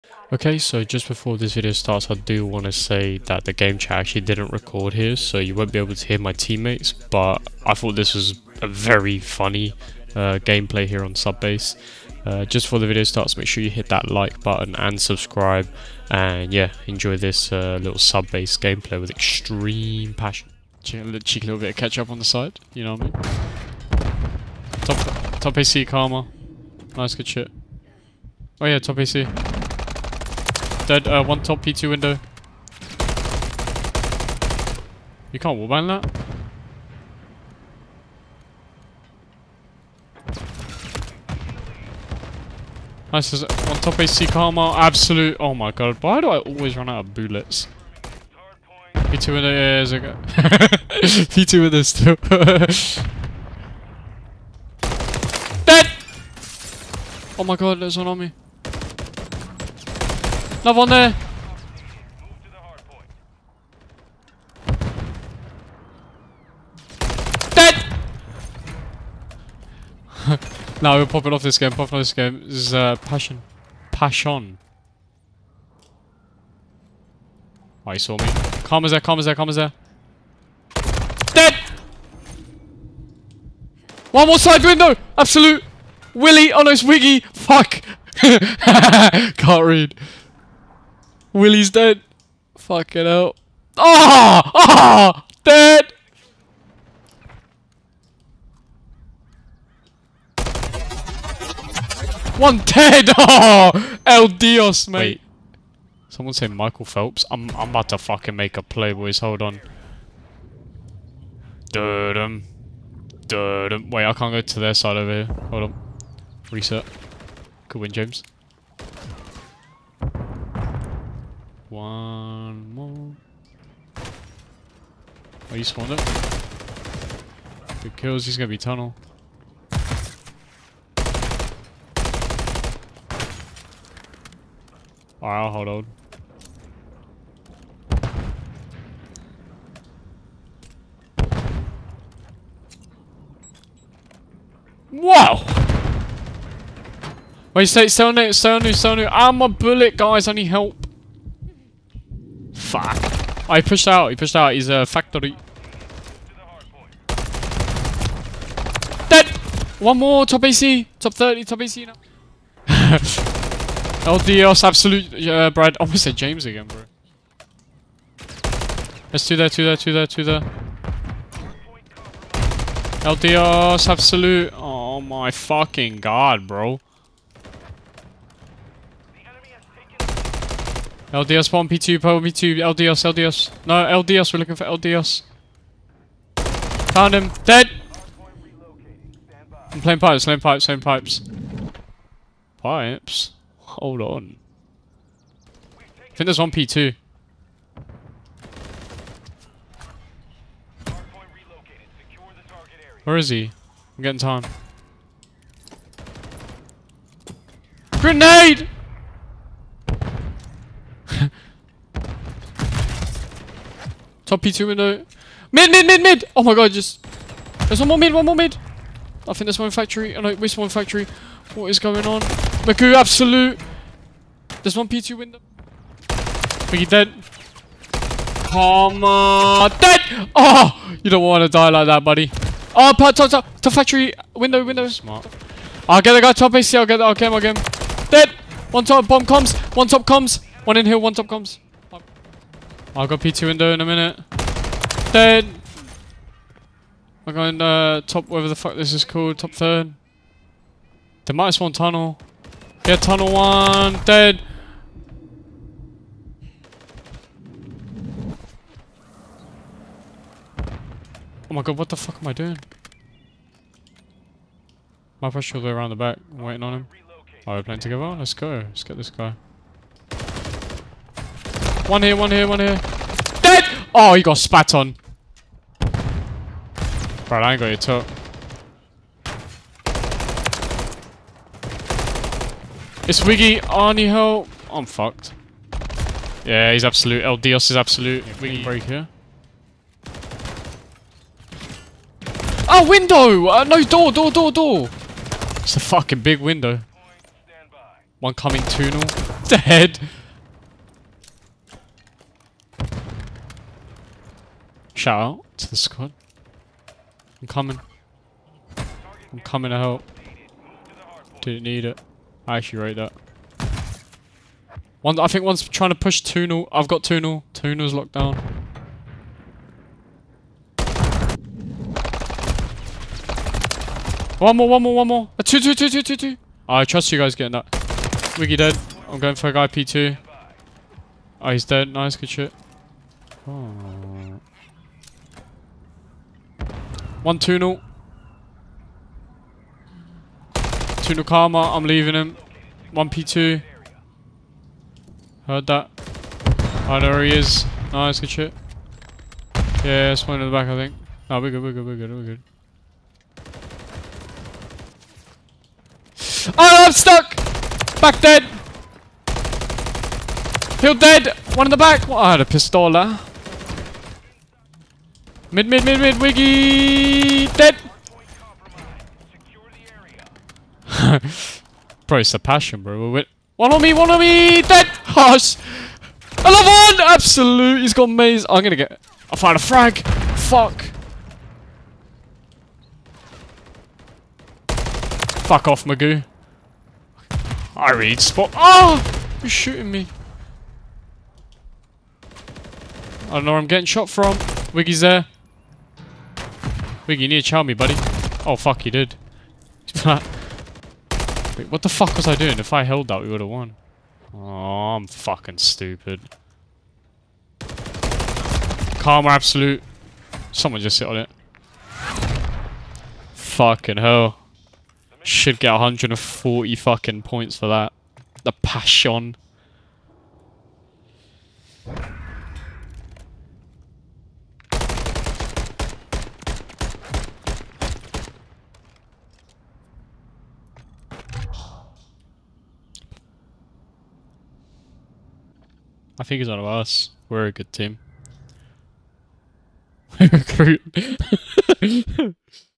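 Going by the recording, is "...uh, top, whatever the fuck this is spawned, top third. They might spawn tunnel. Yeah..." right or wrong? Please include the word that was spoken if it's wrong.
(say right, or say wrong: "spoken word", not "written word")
wrong: "called", not "spawned".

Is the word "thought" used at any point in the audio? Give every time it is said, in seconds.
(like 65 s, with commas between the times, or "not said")
7 s.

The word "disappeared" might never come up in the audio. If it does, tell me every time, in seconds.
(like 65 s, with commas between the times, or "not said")
not said.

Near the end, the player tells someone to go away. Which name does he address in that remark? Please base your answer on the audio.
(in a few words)
Magoo.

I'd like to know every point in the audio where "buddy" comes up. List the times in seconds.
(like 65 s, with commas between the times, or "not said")
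232 s, 397 s.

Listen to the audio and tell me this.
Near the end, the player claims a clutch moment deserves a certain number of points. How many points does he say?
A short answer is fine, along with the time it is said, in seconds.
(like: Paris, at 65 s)
140, at 415 s.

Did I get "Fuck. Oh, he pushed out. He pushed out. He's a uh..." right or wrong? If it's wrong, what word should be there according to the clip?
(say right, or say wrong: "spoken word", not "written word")
right.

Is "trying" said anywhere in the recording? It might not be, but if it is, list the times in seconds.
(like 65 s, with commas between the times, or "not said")
315 s.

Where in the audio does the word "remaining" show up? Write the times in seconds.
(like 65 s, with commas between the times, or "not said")
not said.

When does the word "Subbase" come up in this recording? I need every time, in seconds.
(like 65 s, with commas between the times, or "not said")
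11 s, 17 s.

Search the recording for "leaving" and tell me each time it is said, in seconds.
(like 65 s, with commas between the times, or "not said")
341 s.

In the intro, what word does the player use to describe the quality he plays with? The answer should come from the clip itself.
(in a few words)
extreme passion.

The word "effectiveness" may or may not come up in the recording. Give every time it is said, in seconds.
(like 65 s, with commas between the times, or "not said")
not said.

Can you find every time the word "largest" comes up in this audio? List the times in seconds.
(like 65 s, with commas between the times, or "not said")
not said.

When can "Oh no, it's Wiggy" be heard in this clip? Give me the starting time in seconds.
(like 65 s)
86 s.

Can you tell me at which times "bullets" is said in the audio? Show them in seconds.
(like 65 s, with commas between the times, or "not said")
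47 s, 149 s.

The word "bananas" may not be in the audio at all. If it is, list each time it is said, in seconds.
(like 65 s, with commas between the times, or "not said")
not said.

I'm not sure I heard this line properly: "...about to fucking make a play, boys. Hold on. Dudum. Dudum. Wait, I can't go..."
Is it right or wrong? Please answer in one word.
right.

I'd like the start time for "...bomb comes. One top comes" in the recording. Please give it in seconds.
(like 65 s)
239 s.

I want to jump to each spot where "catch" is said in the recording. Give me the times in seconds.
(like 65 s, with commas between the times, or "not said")
21 s.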